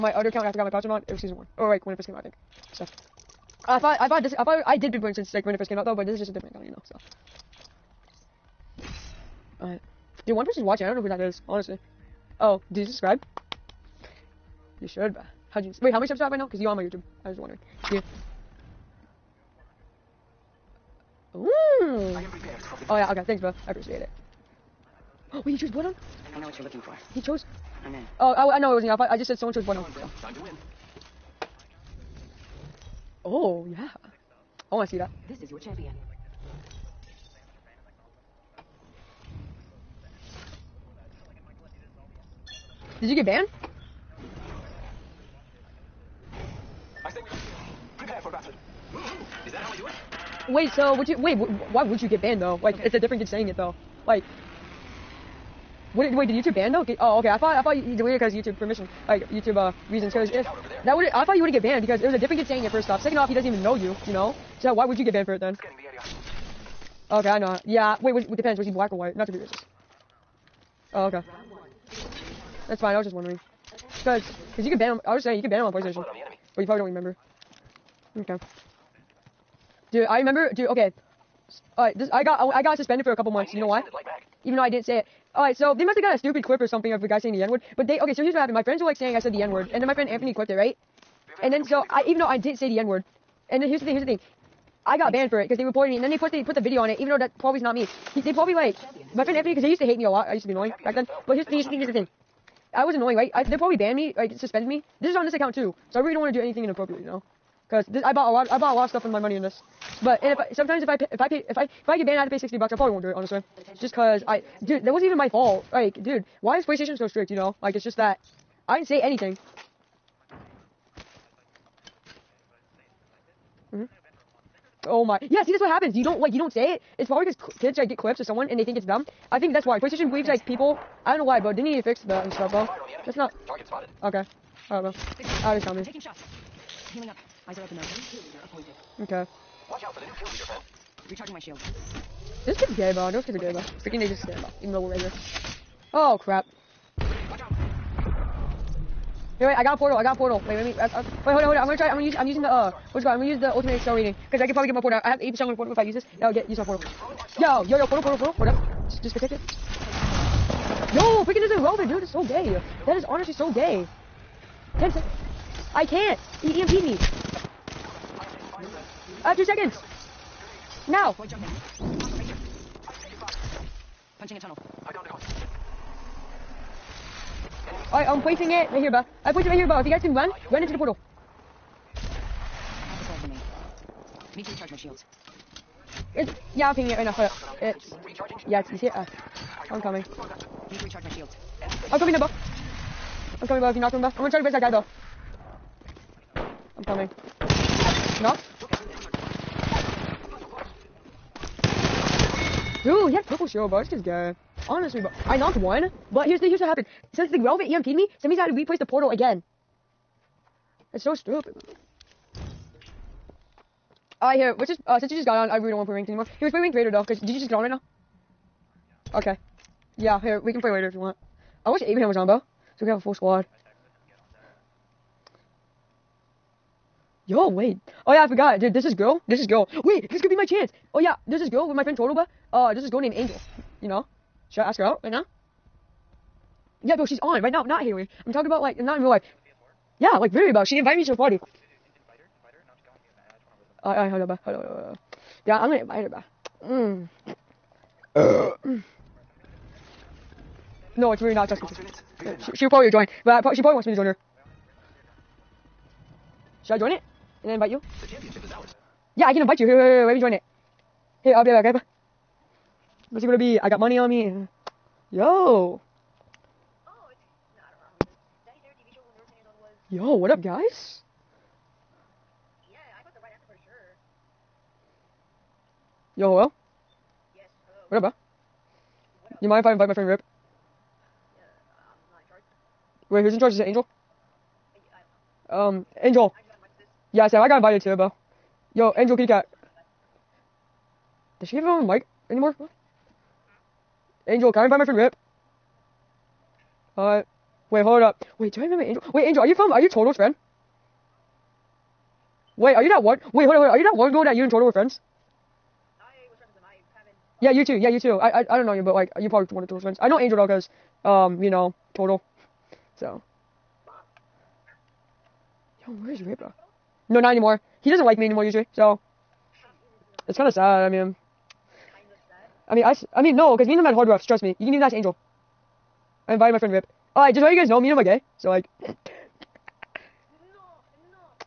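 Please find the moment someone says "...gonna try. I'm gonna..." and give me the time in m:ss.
2:31.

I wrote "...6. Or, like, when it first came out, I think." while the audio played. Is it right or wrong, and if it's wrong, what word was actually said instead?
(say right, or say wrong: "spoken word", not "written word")
wrong: "1", not "6".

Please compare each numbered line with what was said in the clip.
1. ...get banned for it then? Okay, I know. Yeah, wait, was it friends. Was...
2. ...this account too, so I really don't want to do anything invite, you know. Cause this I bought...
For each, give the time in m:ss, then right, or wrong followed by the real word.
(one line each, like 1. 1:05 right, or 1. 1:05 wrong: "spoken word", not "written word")
1. 1:05 wrong: "depends", not "friends"
2. 1:45 wrong: "inappropriate", not "invite".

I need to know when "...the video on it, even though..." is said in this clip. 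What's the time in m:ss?
1:36.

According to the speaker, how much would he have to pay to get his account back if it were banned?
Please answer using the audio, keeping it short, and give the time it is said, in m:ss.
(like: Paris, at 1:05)
$60, at 1:52.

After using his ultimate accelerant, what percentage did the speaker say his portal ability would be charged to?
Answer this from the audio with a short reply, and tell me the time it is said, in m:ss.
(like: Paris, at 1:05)
80%, at 2:35.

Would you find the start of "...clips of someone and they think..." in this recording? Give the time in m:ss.
2:07.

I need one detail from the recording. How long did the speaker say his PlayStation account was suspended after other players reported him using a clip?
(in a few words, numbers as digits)
A couple months.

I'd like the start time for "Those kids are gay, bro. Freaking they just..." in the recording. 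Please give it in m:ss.
2:23.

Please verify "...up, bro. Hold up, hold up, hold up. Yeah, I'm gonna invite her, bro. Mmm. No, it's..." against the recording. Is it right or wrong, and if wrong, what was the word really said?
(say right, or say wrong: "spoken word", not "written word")
right.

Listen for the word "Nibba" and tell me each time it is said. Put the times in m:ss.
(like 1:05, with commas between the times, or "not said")
3:12.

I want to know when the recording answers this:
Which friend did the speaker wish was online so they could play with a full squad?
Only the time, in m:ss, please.
3:41.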